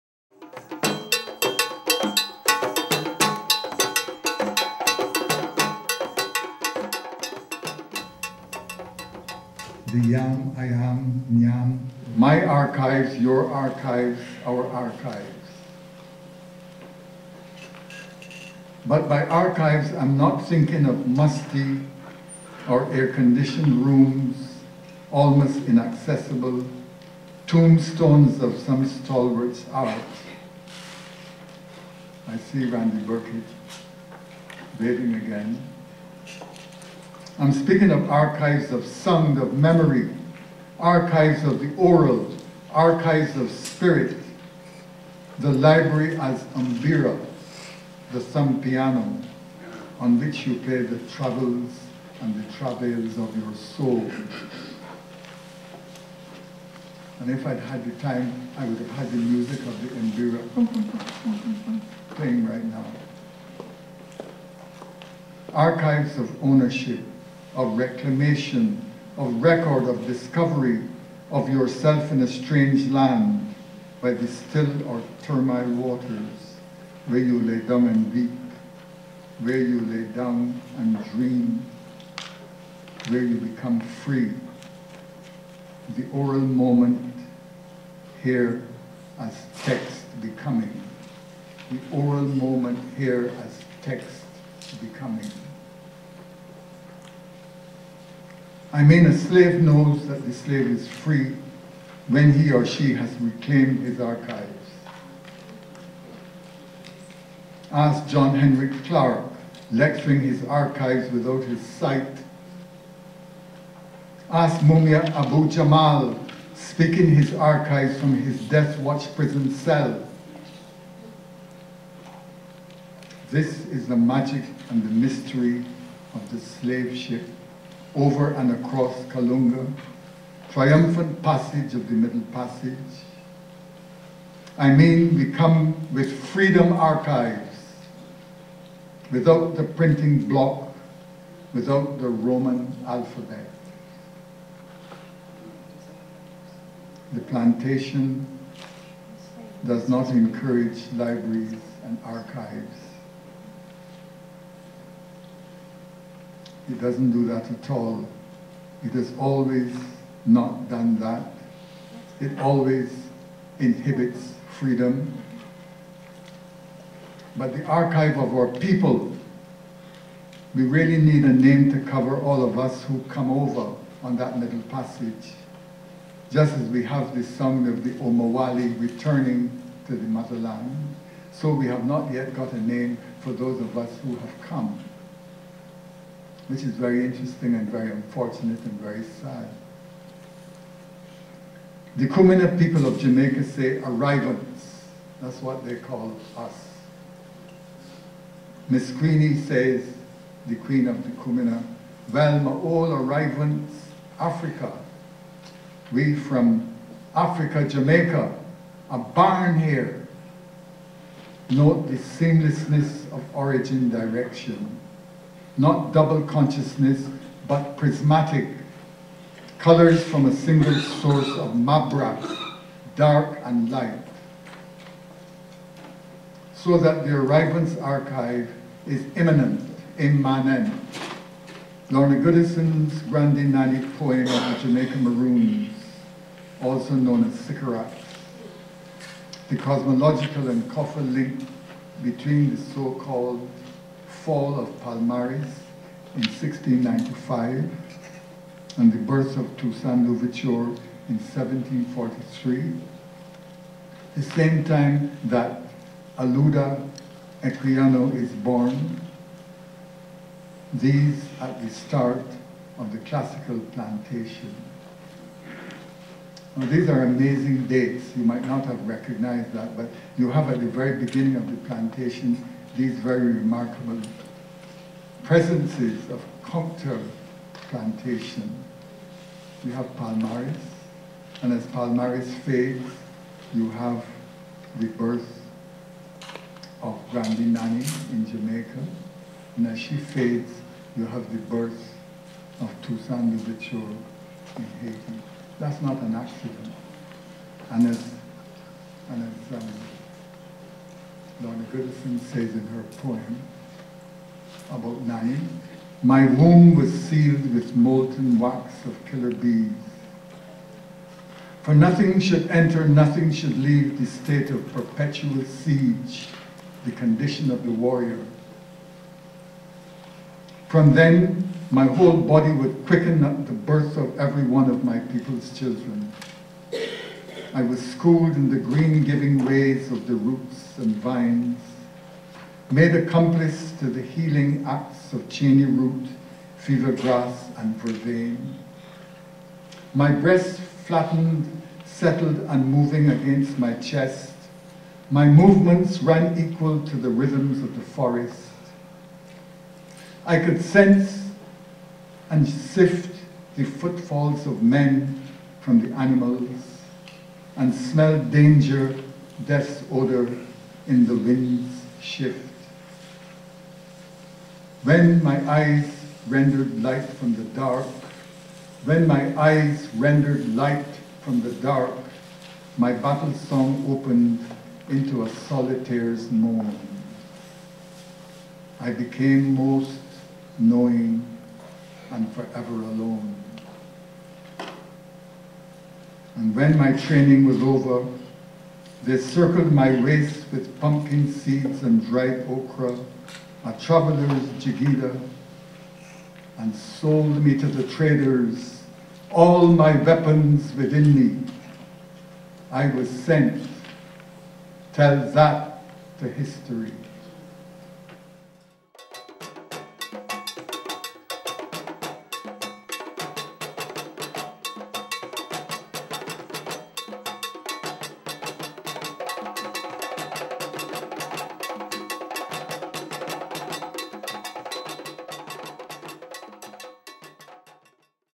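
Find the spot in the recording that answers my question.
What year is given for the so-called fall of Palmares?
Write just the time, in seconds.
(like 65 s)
246 s.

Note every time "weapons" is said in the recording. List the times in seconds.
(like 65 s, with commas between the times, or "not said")
400 s.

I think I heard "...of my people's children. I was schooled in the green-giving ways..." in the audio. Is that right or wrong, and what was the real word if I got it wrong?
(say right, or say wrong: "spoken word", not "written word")
right.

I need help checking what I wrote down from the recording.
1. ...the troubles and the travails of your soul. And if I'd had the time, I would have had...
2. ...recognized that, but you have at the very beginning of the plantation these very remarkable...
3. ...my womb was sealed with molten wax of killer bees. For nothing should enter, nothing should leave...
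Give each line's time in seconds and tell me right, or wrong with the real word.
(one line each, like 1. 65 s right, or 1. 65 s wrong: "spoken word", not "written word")
1. 50 s right
2. 268 s right
3. 306 s right.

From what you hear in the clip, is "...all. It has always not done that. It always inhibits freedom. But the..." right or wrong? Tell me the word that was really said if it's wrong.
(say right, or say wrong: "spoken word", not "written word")
right.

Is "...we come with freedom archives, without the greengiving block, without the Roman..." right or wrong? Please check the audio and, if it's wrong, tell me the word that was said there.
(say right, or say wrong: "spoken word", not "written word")
wrong: "printing", not "greengiving".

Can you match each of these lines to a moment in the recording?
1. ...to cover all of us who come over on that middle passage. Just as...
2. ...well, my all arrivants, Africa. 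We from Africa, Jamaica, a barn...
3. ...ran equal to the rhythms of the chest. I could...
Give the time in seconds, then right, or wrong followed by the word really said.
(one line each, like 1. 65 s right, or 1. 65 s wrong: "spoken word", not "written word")
1. 171 s right
2. 202 s right
3. 346 s wrong: "forest", not "chest".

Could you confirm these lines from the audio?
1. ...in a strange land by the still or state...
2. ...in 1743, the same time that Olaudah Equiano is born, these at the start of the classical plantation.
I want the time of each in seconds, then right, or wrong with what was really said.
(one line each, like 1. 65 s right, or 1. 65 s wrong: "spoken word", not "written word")
1. 72 s wrong: "termite", not "state"
2. 251 s right.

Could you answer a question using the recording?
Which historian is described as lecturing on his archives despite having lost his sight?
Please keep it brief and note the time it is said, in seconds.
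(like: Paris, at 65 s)
John Henrik Clarke, at 108 s.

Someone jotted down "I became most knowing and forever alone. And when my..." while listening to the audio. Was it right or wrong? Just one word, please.
right.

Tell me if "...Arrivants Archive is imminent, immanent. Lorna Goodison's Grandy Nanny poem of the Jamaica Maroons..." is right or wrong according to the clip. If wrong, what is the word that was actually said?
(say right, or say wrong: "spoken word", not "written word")
right.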